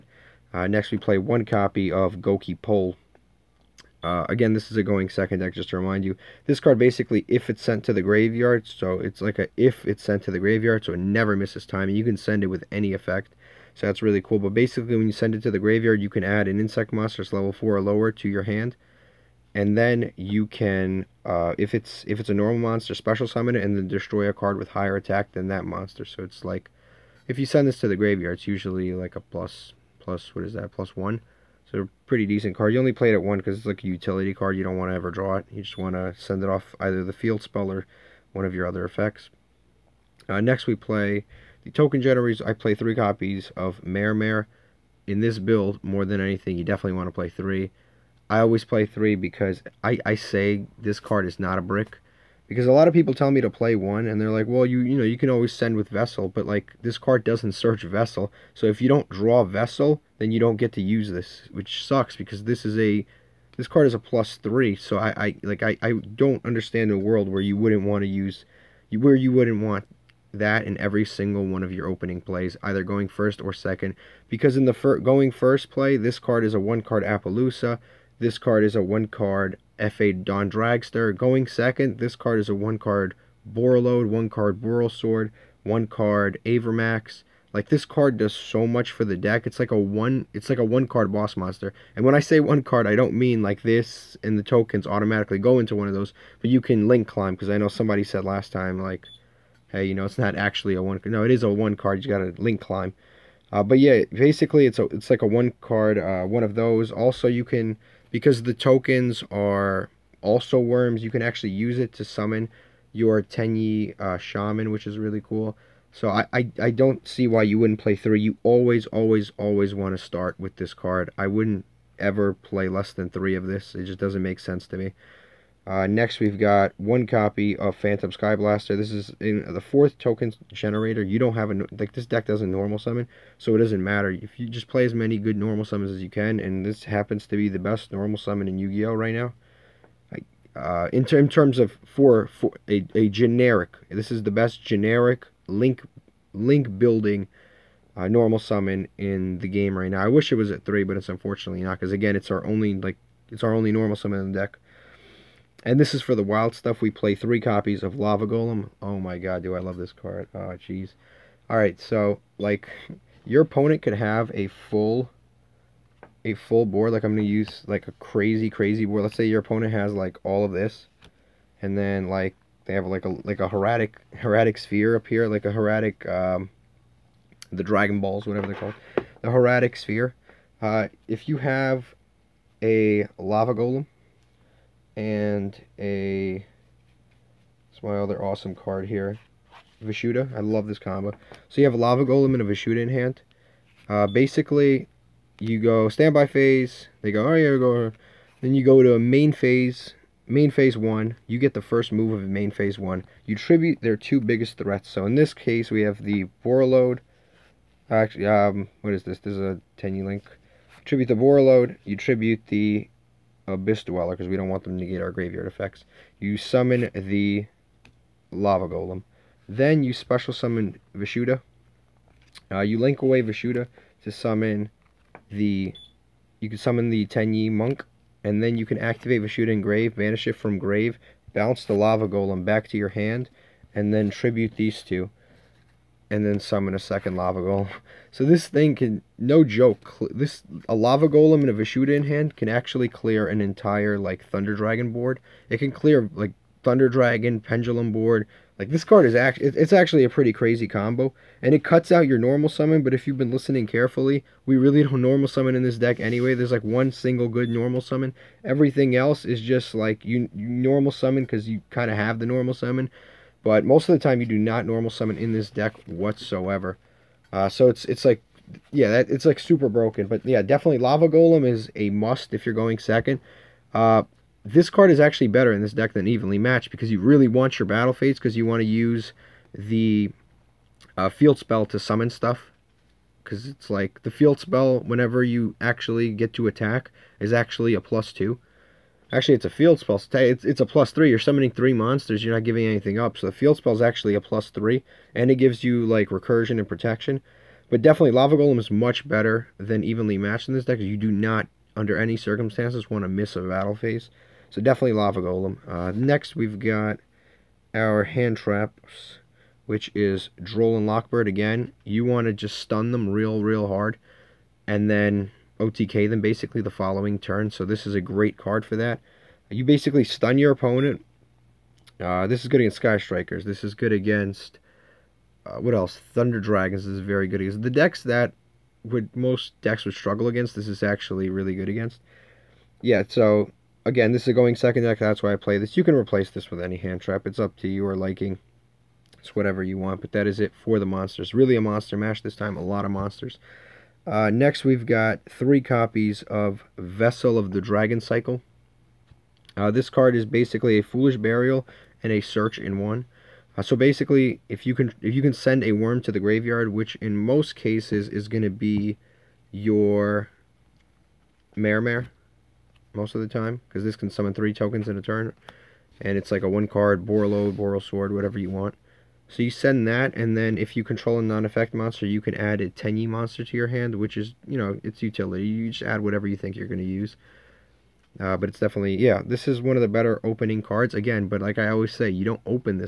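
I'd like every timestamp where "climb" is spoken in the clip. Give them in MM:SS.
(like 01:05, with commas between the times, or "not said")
01:37, 01:42.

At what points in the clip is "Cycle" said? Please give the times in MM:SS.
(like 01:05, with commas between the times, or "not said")
05:47.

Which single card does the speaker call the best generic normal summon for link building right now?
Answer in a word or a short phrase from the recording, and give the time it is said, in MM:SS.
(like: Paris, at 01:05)
Phantom Skyblaster, at 02:07.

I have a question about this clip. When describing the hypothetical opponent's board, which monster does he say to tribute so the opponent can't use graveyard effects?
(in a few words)
Abyss Dweller.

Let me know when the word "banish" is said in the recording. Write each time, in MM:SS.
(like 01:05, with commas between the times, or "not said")
03:49.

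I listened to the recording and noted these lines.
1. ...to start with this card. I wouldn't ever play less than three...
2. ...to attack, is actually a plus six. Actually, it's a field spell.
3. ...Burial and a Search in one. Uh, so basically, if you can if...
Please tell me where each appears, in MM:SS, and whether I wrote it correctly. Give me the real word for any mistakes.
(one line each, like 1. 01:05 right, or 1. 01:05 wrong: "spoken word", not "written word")
1. 01:59 right
2. 04:46 wrong: "two", not "six"
3. 05:51 right.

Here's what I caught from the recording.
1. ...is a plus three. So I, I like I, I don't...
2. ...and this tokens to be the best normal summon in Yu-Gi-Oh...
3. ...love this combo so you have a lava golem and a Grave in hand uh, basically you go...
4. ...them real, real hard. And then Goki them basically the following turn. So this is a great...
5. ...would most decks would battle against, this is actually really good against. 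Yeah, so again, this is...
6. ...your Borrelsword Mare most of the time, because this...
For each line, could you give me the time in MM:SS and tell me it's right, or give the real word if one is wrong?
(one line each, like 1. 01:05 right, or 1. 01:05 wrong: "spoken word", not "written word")
1. 01:03 right
2. 02:16 wrong: "happens", not "tokens"
3. 03:10 wrong: "Vishuda", not "Grave"
4. 05:12 wrong: "OTK", not "Goki"
5. 05:28 wrong: "struggle", not "battle"
6. 05:59 wrong: "Mare", not "Borrelsword".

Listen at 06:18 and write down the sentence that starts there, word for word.
Uh, but it's definitely, yeah, this is one of the better opening cards.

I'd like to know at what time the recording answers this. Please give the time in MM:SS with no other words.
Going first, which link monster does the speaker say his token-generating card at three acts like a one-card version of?
01:17.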